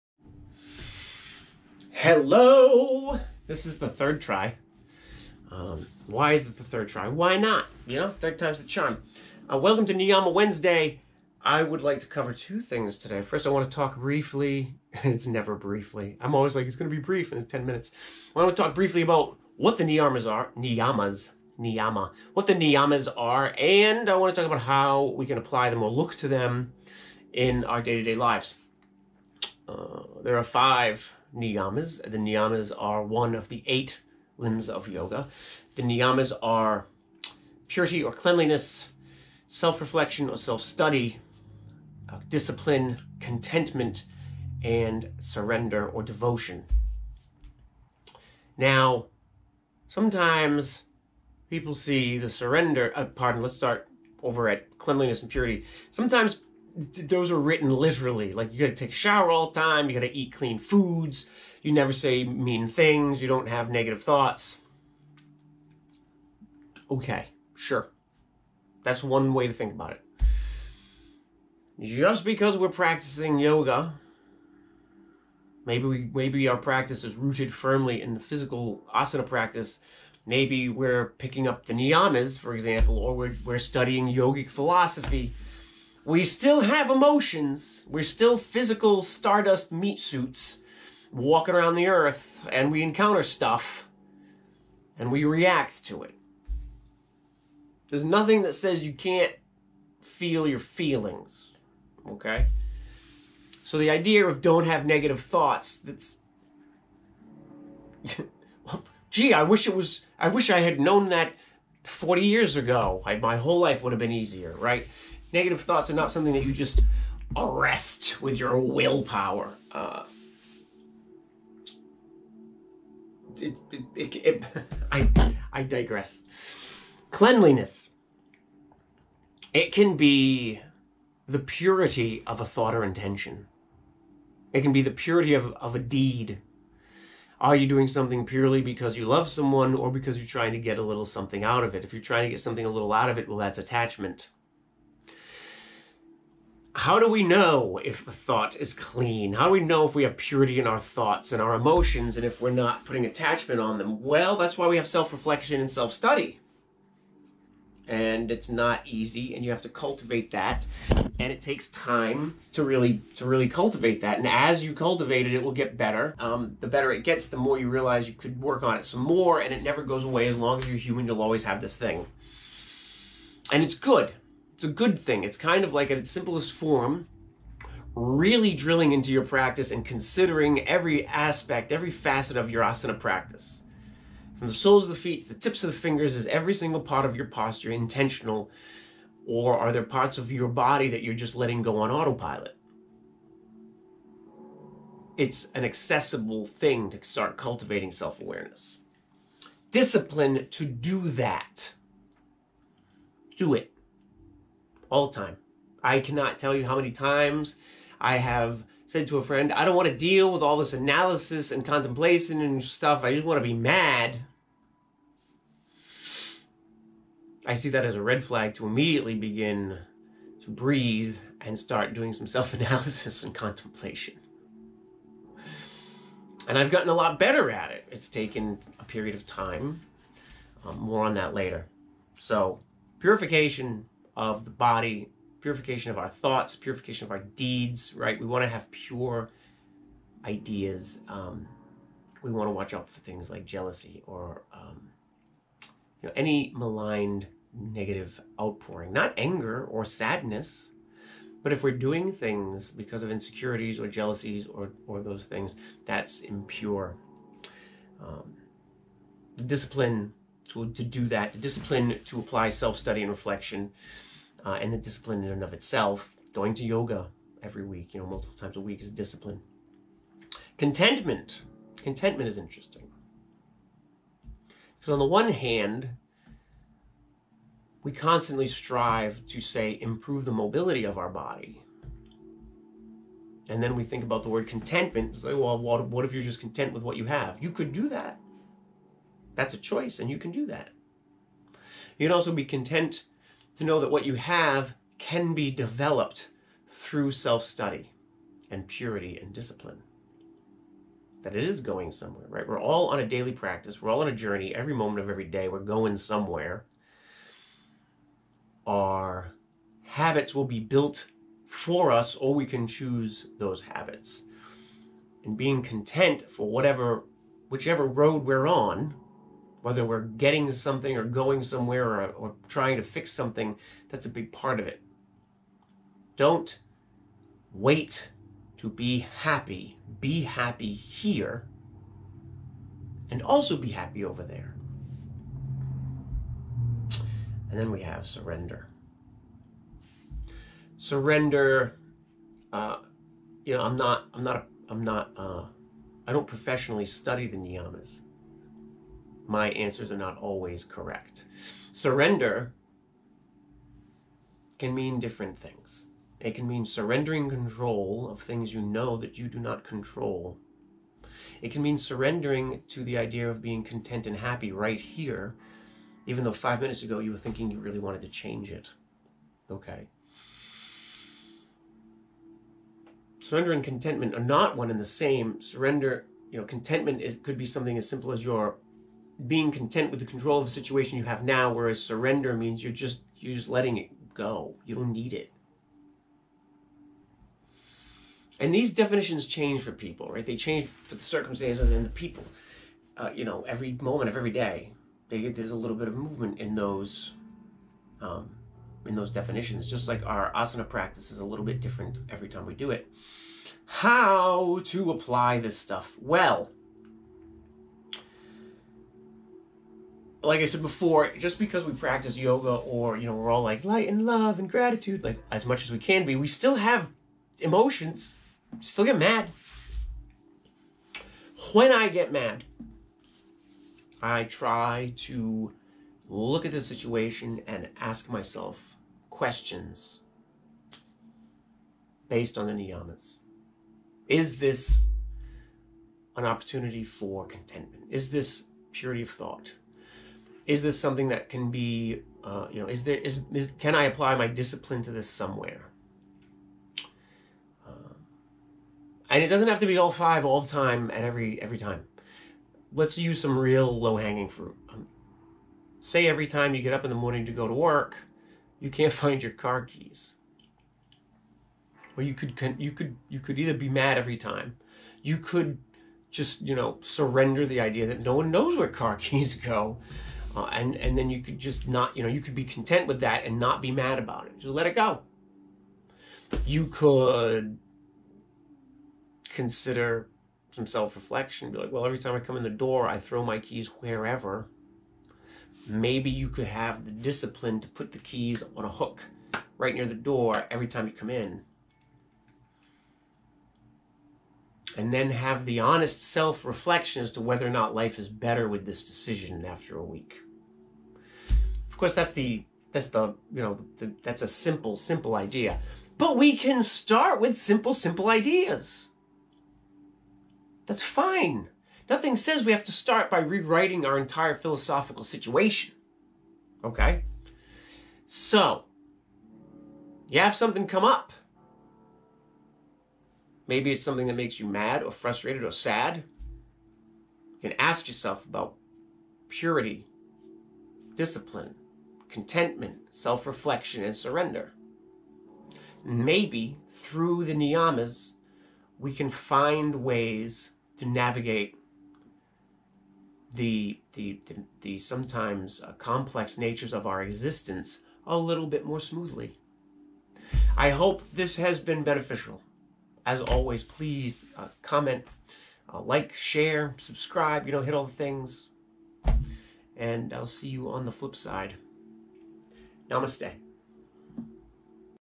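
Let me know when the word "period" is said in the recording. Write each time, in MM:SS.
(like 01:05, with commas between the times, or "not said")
03:48.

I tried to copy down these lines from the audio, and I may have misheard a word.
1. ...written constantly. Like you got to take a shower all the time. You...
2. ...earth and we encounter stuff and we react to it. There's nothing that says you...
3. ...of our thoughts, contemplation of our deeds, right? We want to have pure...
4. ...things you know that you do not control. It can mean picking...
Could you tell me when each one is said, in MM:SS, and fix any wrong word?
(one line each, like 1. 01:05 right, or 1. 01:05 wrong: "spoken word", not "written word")
1. 00:57 wrong: "literally", not "constantly"
2. 01:31 right
3. 03:55 wrong: "purification", not "contemplation"
4. 05:58 wrong: "surrendering", not "picking".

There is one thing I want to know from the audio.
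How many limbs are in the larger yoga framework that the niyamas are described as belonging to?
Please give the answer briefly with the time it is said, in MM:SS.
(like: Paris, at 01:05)
8, at 00:33.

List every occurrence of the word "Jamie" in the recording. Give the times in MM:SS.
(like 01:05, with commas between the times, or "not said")
not said.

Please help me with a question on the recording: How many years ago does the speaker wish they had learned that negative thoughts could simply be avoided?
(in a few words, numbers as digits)
40.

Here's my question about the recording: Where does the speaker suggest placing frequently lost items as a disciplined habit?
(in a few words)
a hook.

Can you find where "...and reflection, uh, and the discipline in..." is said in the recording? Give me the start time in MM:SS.
04:23.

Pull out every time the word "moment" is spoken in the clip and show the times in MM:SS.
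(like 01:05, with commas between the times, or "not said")
05:04, 06:33.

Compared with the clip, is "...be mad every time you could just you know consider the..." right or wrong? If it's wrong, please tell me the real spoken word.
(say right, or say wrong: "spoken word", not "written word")
wrong: "surrender", not "consider".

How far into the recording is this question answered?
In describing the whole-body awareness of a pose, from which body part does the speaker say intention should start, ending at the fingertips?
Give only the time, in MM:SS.
03:04.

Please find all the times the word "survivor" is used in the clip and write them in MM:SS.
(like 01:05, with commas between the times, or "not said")
not said.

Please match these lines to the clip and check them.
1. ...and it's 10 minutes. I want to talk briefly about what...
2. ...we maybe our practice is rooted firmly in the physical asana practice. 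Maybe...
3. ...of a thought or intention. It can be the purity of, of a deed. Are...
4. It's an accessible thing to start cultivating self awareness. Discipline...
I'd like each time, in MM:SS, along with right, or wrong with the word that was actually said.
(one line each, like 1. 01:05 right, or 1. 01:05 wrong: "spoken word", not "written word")
1. 00:17 right
2. 01:15 right
3. 02:12 right
4. 03:15 right.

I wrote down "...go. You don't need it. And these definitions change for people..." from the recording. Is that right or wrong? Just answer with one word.
right.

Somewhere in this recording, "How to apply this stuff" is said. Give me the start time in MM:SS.
06:43.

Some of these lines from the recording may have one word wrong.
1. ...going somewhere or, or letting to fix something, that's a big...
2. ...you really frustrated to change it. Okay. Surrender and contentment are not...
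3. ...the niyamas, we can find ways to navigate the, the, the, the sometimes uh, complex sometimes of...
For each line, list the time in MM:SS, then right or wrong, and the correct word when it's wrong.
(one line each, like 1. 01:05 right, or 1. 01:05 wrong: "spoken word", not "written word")
1. 05:21 wrong: "trying", not "letting"
2. 06:07 wrong: "wanted", not "frustrated"
3. 08:57 wrong: "natures", not "sometimes".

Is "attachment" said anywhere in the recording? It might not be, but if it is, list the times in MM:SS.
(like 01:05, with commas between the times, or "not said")
02:23, 02:33.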